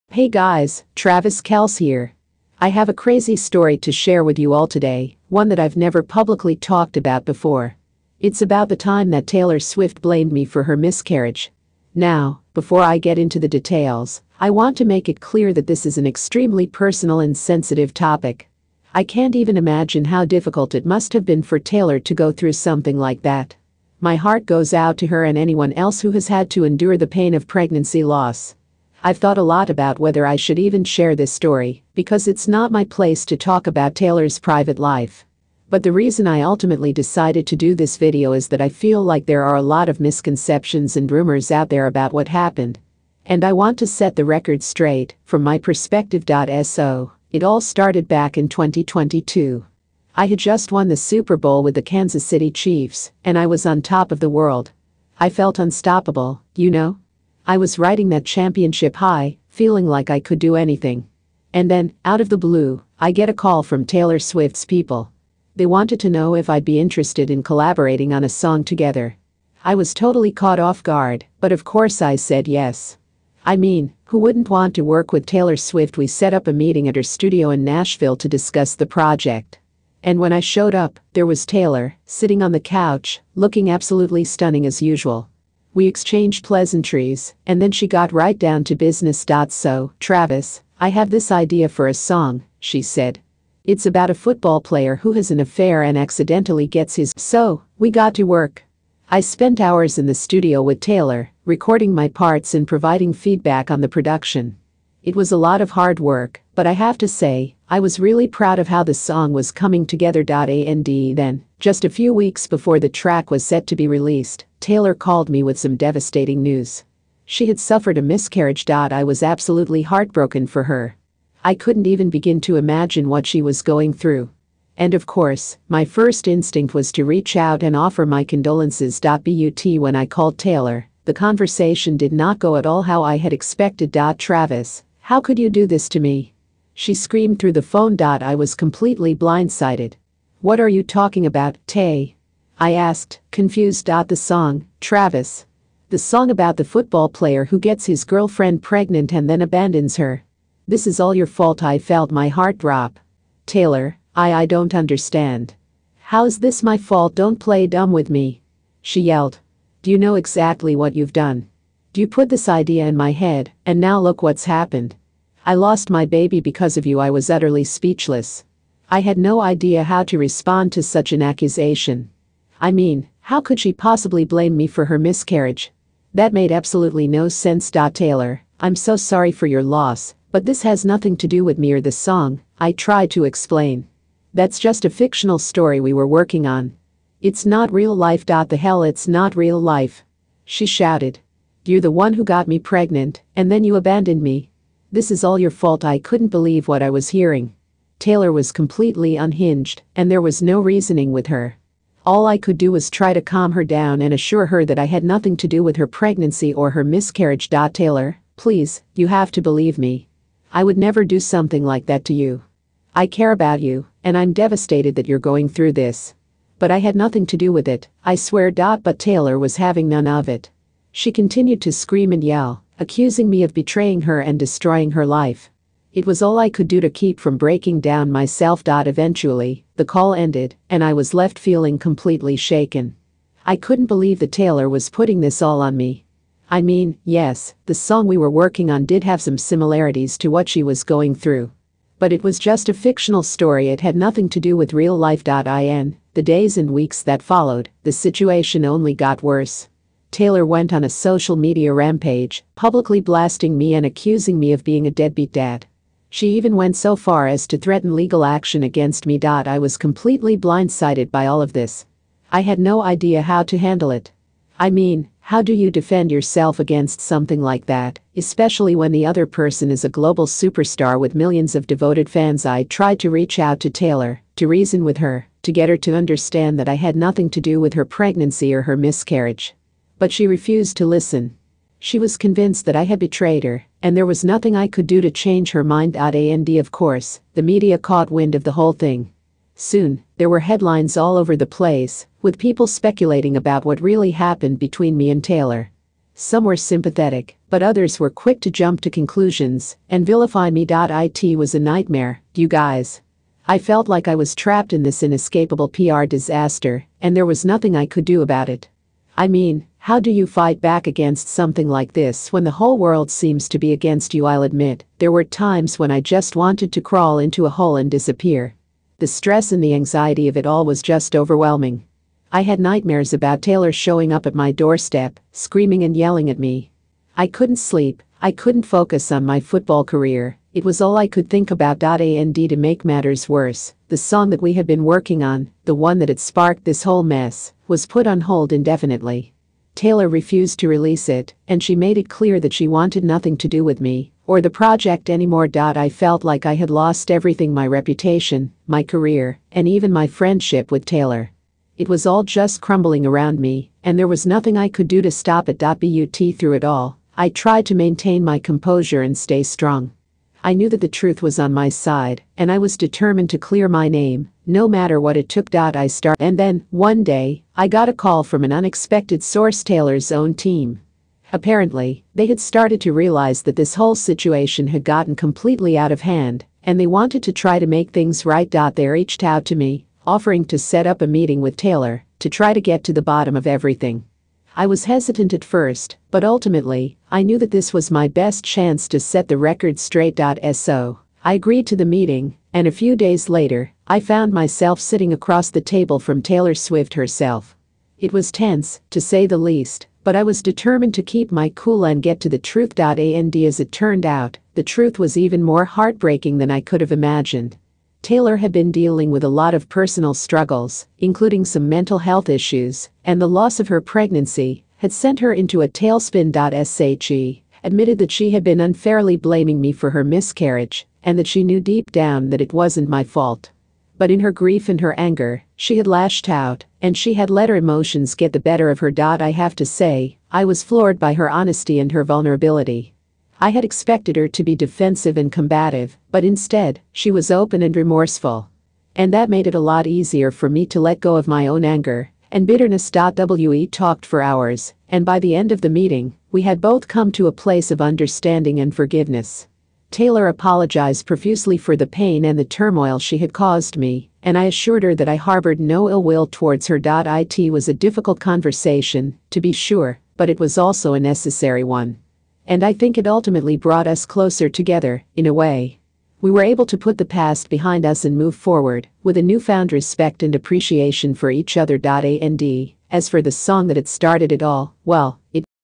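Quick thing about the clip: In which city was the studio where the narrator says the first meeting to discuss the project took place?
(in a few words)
Nashville.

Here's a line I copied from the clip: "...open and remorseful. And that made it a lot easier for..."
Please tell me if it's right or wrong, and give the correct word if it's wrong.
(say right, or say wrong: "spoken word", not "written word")
right.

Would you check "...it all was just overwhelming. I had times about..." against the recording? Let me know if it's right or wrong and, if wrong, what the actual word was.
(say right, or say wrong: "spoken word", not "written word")
wrong: "nightmares", not "times".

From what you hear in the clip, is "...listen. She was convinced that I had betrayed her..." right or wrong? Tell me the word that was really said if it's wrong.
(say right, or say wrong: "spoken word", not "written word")
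right.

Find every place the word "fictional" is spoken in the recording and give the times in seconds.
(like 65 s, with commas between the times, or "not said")
184 s, 242 s.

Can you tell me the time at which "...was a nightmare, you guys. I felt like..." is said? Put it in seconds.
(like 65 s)
301 s.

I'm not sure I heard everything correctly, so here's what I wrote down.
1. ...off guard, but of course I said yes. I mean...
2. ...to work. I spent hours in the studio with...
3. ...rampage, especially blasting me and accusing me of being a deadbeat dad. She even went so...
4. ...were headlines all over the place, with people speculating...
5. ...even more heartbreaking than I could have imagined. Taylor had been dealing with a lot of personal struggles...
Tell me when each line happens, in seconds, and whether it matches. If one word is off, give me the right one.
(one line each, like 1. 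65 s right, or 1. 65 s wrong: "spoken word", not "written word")
1. 70 s right
2. 98 s right
3. 251 s wrong: "publicly", not "especially"
4. 290 s right
5. 405 s right.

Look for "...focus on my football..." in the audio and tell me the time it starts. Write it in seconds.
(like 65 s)
328 s.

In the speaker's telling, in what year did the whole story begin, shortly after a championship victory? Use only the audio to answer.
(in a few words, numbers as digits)
2022.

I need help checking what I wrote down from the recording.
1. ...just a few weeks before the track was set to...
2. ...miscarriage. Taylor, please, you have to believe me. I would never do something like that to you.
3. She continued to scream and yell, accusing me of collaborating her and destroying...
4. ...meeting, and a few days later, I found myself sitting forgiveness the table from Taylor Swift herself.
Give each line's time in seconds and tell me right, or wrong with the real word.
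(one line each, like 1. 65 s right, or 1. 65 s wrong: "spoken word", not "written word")
1. 111 s right
2. 206 s right
3. 220 s wrong: "betraying", not "collaborating"
4. 391 s wrong: "across", not "forgiveness".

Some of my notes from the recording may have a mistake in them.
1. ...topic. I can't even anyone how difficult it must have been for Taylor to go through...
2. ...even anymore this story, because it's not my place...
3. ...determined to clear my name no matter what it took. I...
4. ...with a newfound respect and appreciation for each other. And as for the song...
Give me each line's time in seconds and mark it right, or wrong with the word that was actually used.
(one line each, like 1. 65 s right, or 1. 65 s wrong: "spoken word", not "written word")
1. 17 s wrong: "imagine", not "anyone"
2. 30 s wrong: "share", not "anymore"
3. 362 s right
4. 469 s right.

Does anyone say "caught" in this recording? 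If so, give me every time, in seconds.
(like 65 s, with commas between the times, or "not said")
70 s, 287 s.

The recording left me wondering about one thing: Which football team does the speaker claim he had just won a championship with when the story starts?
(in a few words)
Kansas City Chiefs.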